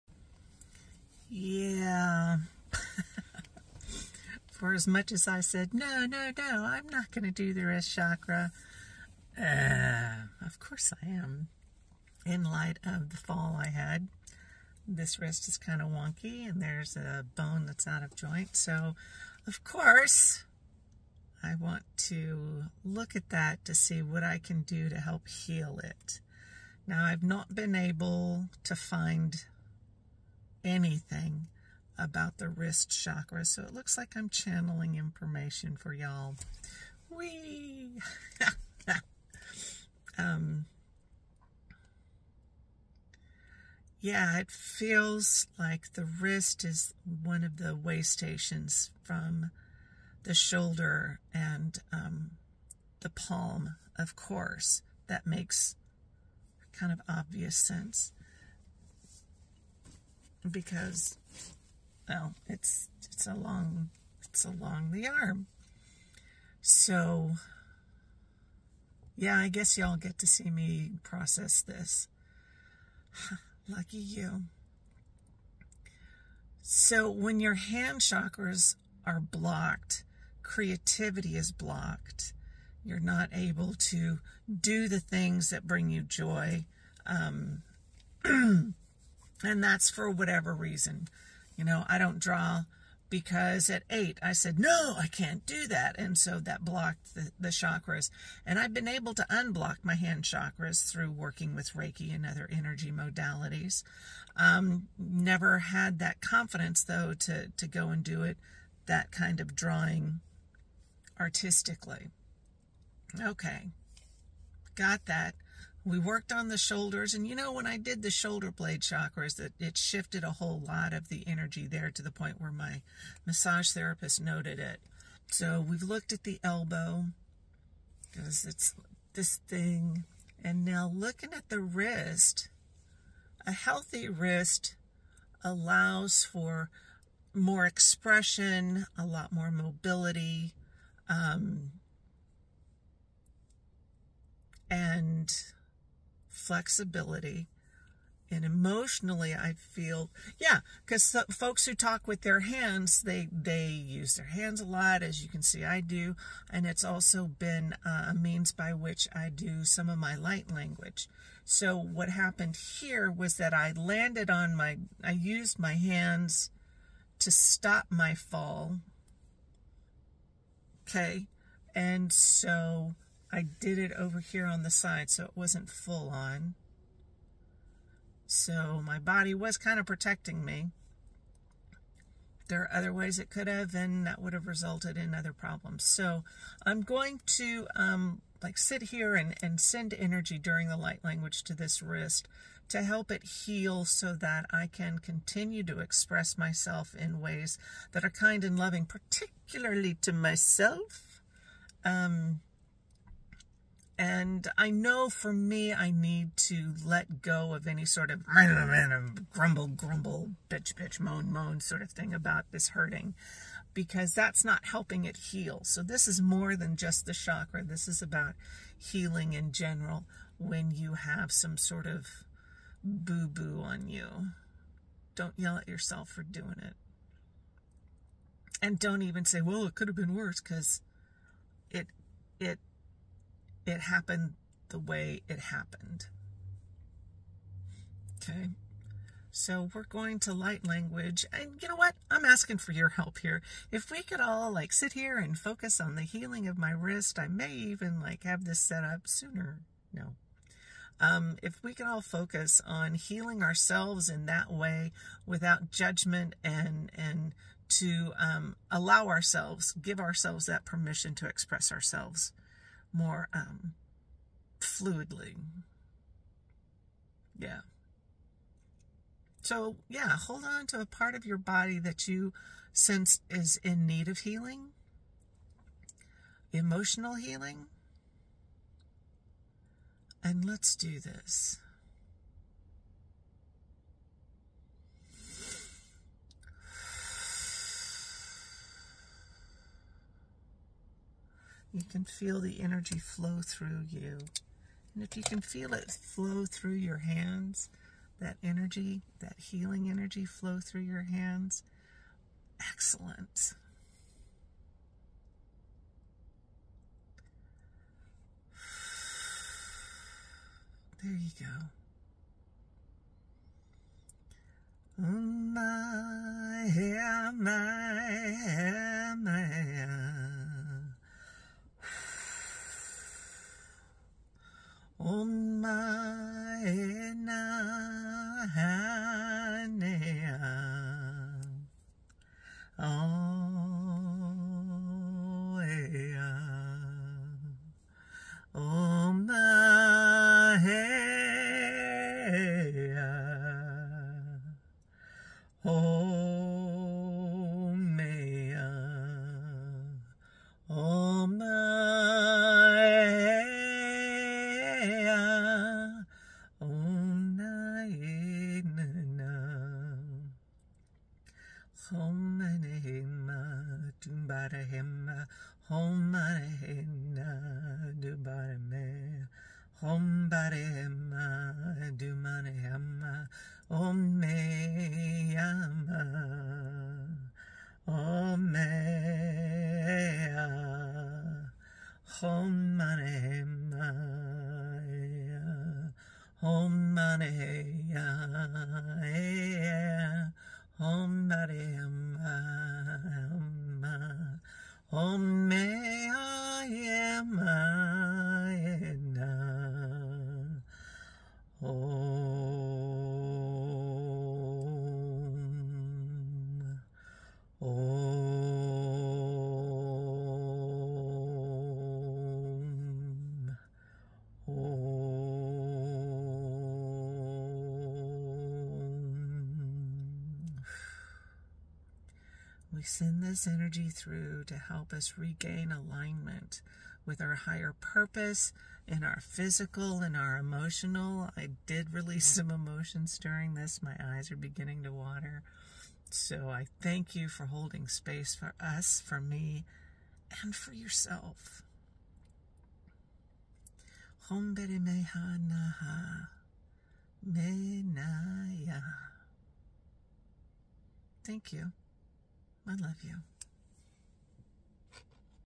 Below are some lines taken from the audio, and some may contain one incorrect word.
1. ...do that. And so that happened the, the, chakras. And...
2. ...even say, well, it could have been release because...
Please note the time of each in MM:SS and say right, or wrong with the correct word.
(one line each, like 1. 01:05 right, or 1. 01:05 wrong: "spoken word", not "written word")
1. 01:35 wrong: "blocked", not "happened"
2. 03:49 wrong: "worse", not "release".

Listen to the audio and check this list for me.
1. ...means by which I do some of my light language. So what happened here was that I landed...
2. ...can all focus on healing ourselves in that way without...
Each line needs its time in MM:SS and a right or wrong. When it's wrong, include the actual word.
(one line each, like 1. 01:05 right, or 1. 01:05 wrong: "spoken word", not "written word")
1. 02:38 right
2. 04:11 right.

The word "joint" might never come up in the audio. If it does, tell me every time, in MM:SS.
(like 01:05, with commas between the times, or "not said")
00:18.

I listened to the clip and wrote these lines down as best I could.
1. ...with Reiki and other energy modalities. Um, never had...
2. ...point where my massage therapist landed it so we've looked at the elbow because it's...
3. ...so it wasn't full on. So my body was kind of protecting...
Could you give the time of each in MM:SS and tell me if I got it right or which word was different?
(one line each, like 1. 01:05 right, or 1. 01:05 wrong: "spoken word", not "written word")
1. 01:41 right
2. 02:02 wrong: "noted", not "landed"
3. 02:55 right.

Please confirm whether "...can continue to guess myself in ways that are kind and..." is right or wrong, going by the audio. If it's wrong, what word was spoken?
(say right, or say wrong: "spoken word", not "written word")
wrong: "express", not "guess".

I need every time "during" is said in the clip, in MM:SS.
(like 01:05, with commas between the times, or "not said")
03:10, 07:13.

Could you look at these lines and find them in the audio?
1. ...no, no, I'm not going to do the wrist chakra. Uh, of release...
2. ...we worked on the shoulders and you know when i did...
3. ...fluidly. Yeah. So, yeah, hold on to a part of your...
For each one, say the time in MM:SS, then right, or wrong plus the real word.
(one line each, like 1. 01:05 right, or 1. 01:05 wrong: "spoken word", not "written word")
1. 00:06 wrong: "course", not "release"
2. 01:55 right
3. 04:24 right.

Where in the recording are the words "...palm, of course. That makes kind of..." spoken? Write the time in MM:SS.
00:53.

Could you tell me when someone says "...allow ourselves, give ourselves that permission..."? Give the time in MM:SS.
04:18.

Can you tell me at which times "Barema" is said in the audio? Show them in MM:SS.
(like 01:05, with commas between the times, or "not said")
06:10, 06:31.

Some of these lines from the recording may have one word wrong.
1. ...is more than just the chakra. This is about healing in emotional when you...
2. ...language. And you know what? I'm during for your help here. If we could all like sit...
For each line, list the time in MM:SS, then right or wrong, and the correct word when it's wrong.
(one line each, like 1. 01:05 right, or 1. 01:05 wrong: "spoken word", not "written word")
1. 03:36 wrong: "general", not "emotional"
2. 04:00 wrong: "asking", not "during".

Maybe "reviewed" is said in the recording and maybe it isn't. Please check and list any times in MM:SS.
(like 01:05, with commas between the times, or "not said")
not said.